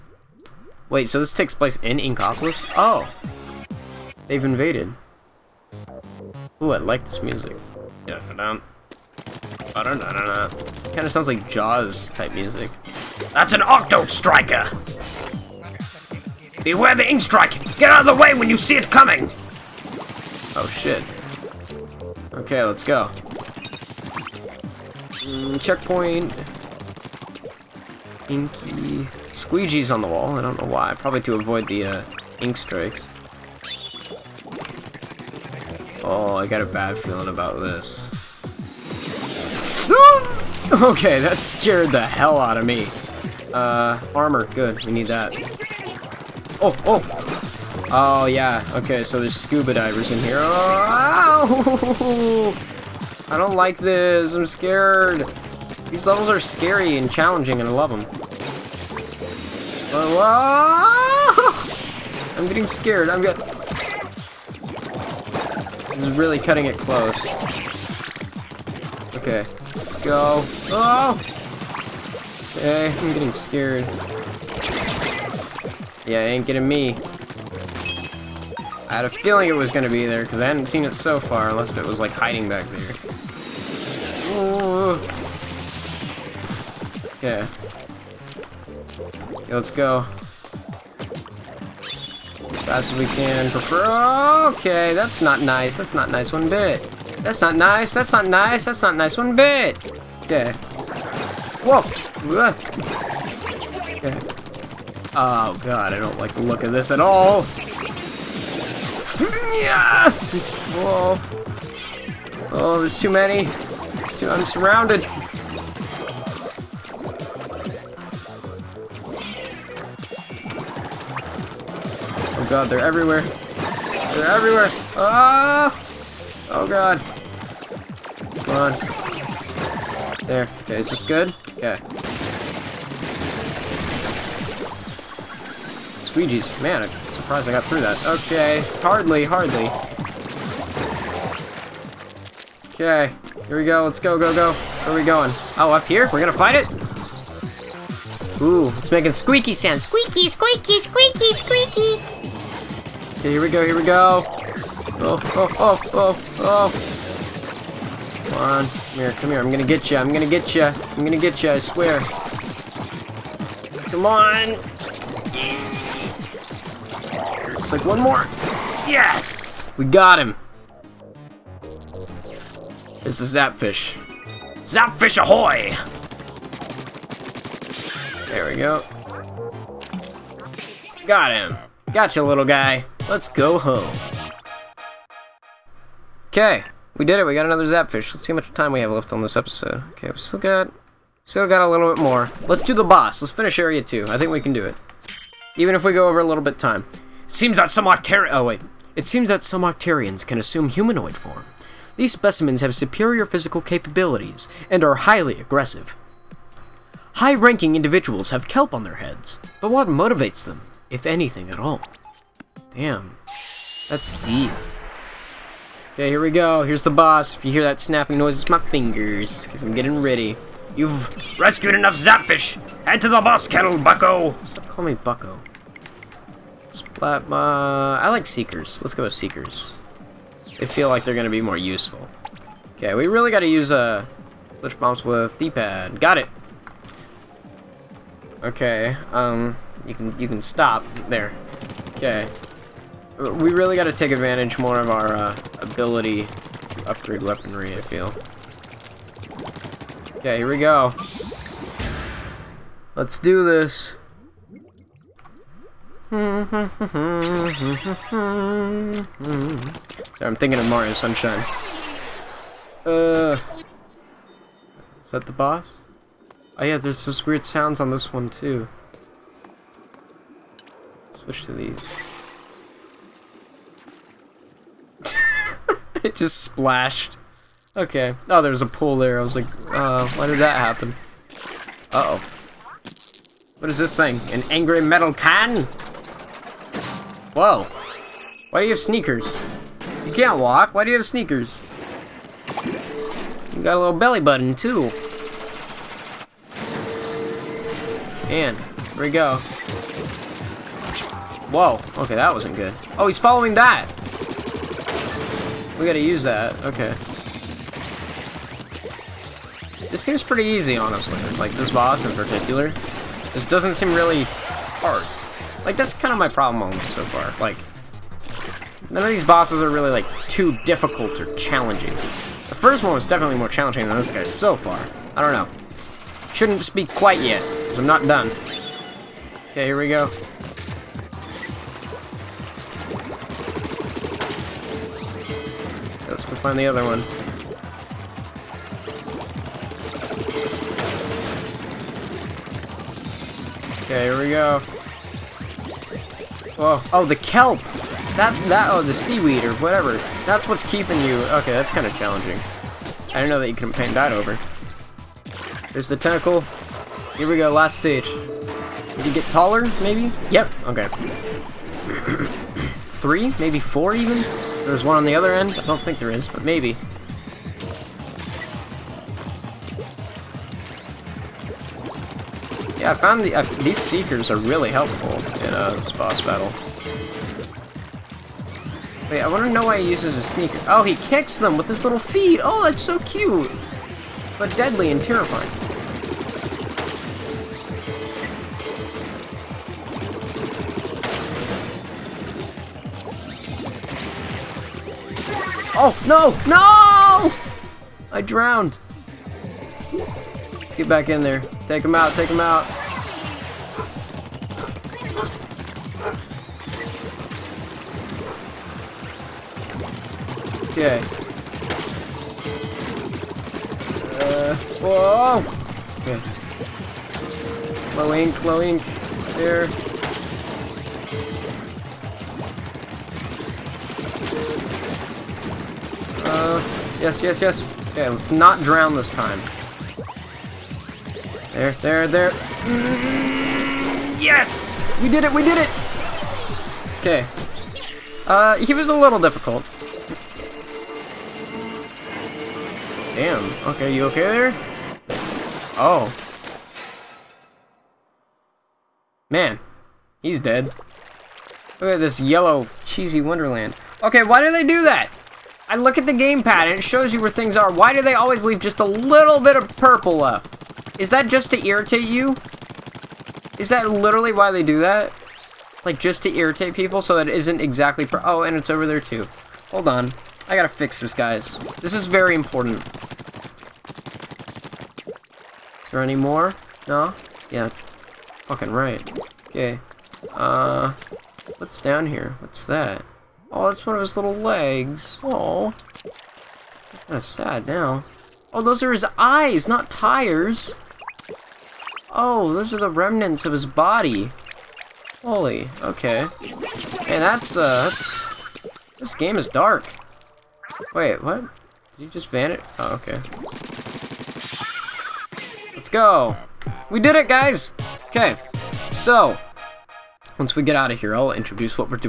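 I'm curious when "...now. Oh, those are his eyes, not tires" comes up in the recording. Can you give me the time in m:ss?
8:07.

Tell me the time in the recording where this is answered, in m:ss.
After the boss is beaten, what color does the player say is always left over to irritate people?
7:39.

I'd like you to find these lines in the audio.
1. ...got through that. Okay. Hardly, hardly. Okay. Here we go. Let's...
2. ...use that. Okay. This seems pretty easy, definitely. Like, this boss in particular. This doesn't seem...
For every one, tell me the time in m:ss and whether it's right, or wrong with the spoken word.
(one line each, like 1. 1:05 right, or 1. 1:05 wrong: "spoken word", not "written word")
1. 2:17 right
2. 5:05 wrong: "honestly", not "definitely".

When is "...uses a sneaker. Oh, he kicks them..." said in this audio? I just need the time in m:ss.
6:19.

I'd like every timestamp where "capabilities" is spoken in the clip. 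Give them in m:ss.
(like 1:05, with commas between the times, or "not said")
3:23.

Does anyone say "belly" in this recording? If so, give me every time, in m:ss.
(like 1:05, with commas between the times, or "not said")
4:53.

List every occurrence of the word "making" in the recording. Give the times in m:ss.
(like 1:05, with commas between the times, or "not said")
2:28.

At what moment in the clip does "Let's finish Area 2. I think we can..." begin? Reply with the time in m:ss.
3:13.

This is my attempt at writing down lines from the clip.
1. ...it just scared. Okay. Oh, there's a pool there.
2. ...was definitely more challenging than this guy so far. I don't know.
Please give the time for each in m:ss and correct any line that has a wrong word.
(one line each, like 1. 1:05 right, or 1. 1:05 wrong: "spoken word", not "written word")
1. 4:36 wrong: "splashed", not "scared"
2. 5:22 right.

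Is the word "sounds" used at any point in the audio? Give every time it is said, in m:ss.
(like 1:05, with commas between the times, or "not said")
0:11, 2:29, 4:27.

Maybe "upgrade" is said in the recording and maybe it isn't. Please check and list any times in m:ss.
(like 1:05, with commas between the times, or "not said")
4:06.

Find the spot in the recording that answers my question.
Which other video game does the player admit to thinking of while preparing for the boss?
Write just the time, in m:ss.
4:20.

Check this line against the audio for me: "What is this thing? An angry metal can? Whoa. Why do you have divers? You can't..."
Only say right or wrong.
wrong.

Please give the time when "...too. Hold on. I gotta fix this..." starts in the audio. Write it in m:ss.
7:48.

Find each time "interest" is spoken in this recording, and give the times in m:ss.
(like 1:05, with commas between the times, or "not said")
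not said.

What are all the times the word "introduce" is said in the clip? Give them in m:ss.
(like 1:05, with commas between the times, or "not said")
8:31.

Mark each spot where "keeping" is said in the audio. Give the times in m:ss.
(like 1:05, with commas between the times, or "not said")
5:50.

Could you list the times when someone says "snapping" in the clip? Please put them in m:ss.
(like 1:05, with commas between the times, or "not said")
3:37.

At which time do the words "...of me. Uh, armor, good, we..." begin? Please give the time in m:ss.
0:42.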